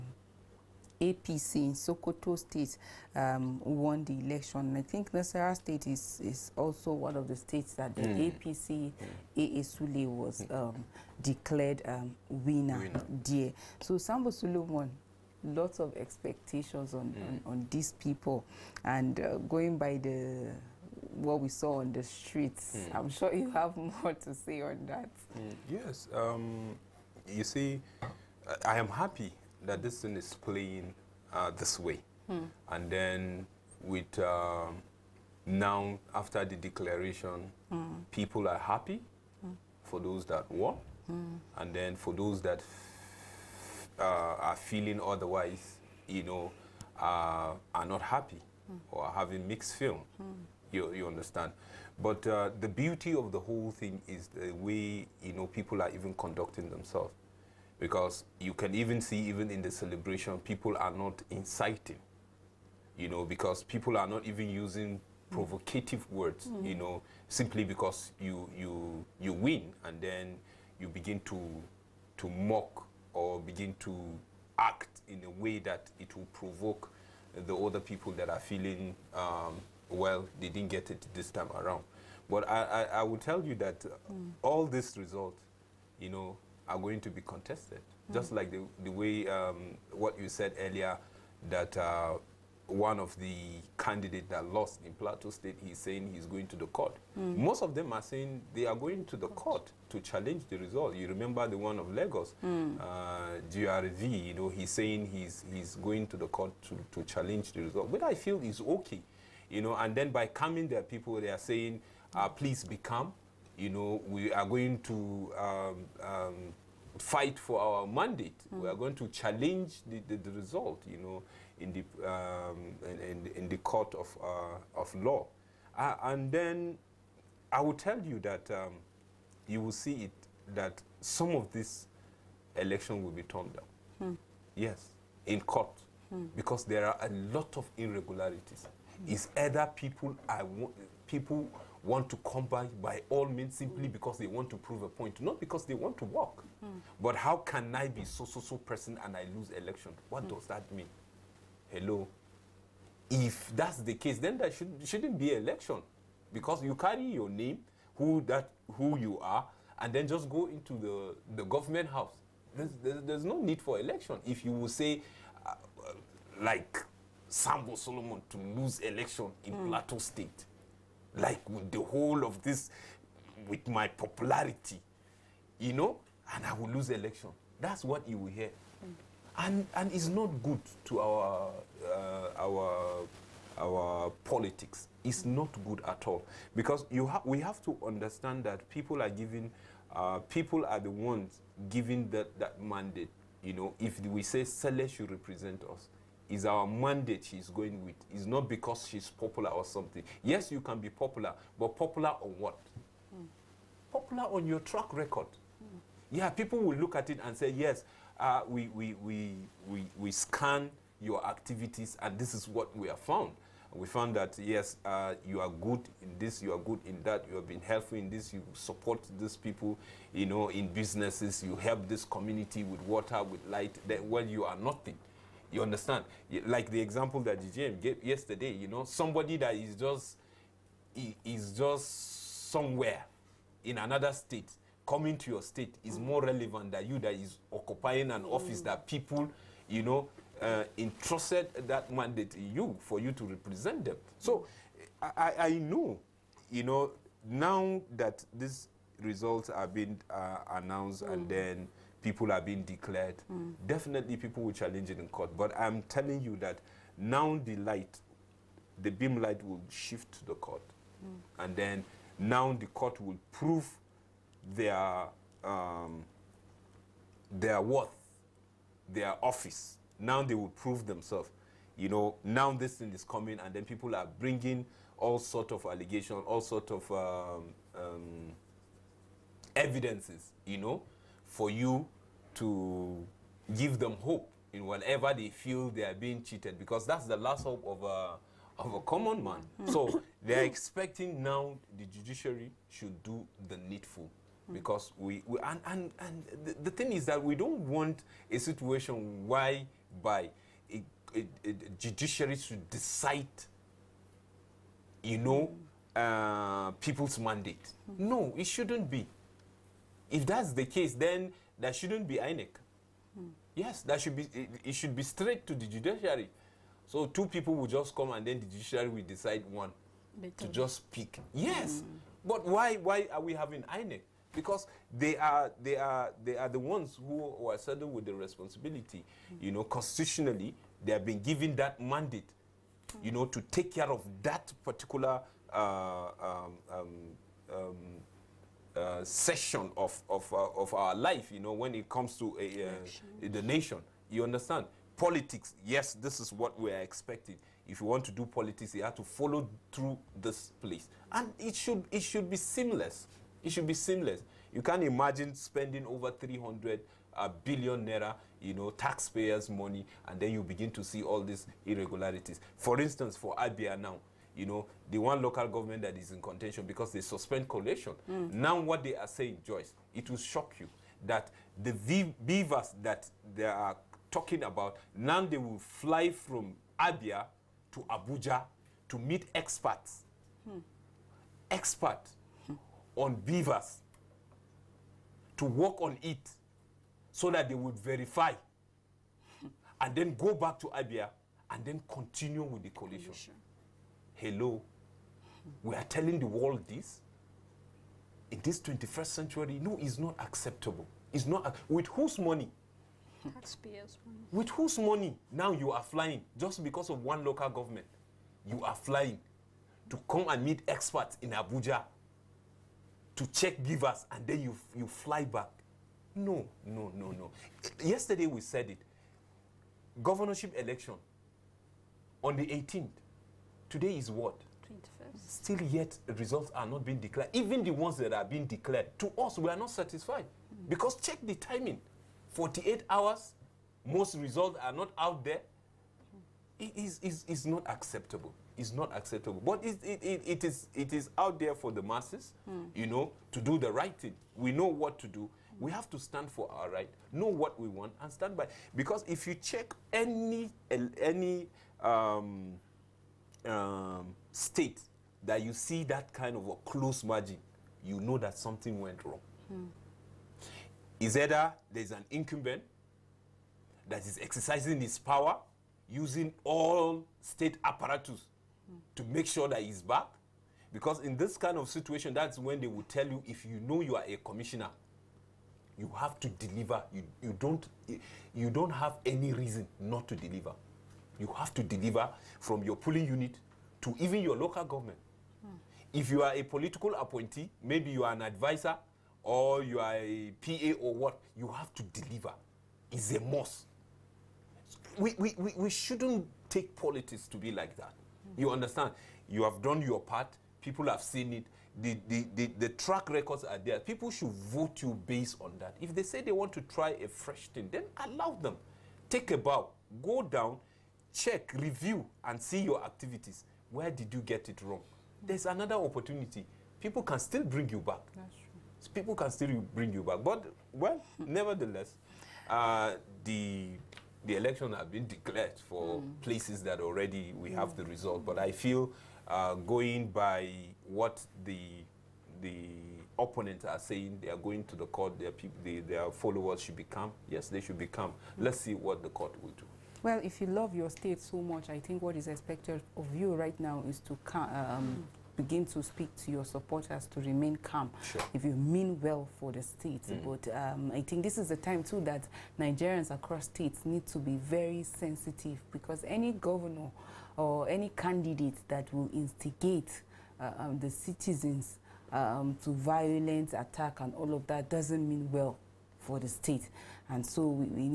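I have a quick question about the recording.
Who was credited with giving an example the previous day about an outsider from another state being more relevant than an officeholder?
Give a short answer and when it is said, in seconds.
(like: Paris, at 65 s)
GGM, at 227 s.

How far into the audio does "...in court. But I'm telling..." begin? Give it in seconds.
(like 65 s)
254 s.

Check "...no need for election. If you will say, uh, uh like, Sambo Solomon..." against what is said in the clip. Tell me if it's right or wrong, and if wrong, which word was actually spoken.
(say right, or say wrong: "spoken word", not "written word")
right.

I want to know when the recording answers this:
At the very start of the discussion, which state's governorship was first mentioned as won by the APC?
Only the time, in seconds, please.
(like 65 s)
1 s.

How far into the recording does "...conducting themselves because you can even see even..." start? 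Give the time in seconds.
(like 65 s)
56 s.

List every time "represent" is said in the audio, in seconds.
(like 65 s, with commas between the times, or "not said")
195 s, 243 s.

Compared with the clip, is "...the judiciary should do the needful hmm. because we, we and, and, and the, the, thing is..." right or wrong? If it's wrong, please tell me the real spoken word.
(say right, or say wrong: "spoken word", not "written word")
right.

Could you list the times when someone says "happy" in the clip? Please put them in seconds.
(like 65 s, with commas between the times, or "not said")
28 s, 38 s, 48 s.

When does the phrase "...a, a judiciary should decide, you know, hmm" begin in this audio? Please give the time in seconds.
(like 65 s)
301 s.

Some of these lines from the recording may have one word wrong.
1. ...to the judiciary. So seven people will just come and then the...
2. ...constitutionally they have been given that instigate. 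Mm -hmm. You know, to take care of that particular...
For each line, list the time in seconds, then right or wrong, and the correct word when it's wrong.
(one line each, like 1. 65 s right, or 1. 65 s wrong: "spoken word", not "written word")
1. 315 s wrong: "two", not "seven"
2. 329 s wrong: "mandate", not "instigate".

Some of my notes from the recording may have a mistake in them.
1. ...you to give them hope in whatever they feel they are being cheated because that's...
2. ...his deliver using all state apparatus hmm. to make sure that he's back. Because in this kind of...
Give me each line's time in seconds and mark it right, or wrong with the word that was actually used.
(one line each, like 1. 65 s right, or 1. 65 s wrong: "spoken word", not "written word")
1. 281 s right
2. 464 s wrong: "power", not "deliver".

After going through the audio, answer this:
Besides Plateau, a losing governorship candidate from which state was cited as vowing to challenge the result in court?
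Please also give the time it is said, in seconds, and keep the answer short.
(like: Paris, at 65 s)
Lagos, at 101 s.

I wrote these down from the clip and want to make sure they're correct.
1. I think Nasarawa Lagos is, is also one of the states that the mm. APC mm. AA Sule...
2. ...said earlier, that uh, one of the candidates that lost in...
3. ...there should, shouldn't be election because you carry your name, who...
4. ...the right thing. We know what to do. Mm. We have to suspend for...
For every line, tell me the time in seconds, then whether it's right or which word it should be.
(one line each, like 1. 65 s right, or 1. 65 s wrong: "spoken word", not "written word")
1. 4 s wrong: "State", not "Lagos"
2. 90 s right
3. 154 s right
4. 443 s wrong: "stand", not "suspend".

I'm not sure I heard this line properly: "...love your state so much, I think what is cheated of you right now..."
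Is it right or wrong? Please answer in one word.
wrong.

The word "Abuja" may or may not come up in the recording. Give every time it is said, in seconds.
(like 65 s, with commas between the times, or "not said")
377 s, 411 s.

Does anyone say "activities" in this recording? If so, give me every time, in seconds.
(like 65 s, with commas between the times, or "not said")
211 s, 512 s.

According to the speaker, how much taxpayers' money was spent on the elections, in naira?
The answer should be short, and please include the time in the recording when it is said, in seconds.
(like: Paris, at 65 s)
Over 300 billion naira, at 356 s.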